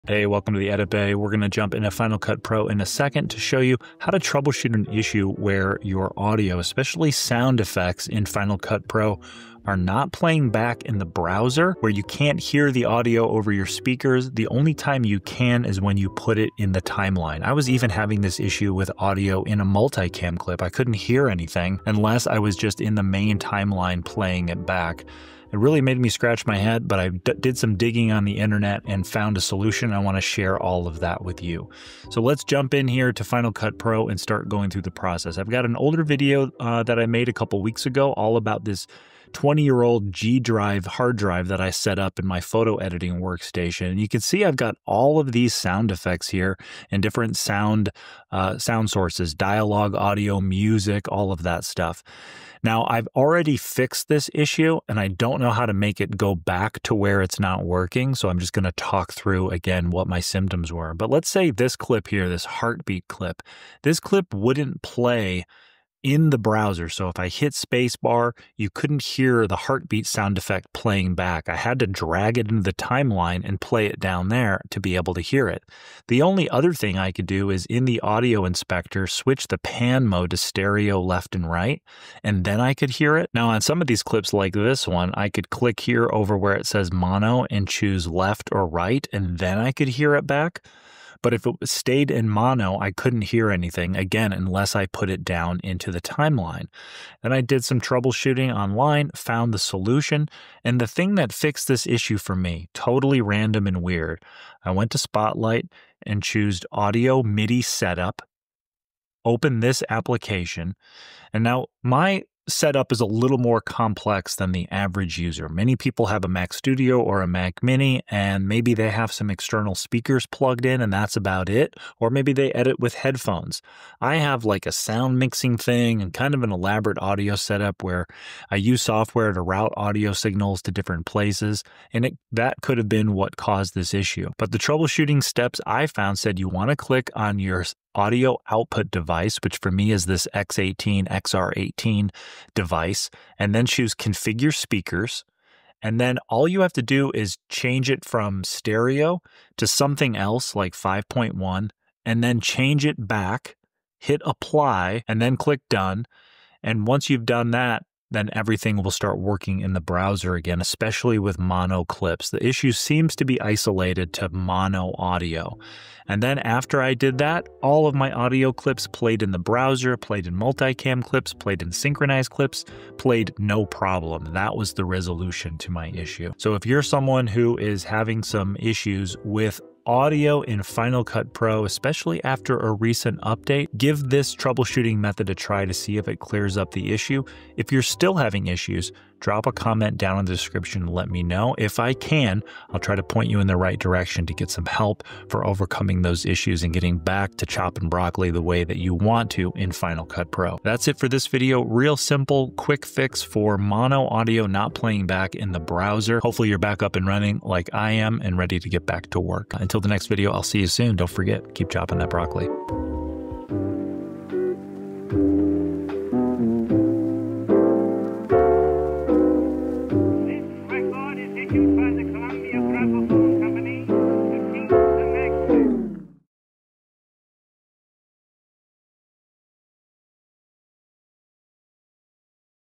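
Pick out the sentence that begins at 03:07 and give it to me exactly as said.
If you're still having issues, drop a comment down in the description and let me know.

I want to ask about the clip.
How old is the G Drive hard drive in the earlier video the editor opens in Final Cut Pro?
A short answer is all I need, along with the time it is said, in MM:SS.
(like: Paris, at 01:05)
20 years, at 00:39.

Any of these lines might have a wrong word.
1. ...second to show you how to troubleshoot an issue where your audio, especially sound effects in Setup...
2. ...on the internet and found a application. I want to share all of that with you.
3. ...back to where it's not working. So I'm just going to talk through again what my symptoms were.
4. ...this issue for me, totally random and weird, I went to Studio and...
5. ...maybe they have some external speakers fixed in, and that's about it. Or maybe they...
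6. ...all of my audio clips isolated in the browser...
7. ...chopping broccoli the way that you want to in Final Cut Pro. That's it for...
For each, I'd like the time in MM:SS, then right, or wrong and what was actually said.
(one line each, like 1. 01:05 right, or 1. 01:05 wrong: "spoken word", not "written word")
1. 00:02 wrong: "Final", not "Setup"
2. 00:28 wrong: "solution", not "application"
3. 00:56 right
4. 01:41 wrong: "Spotlight", not "Studio"
5. 01:58 wrong: "plugged", not "fixed"
6. 02:47 wrong: "played", not "isolated"
7. 03:17 right.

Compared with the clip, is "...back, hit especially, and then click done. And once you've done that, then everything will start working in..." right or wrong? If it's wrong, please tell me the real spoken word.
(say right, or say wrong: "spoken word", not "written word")
wrong: "apply", not "especially".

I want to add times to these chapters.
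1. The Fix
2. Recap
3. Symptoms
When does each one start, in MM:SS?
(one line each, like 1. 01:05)
1. 01:37
2. 02:56
3. 00:32.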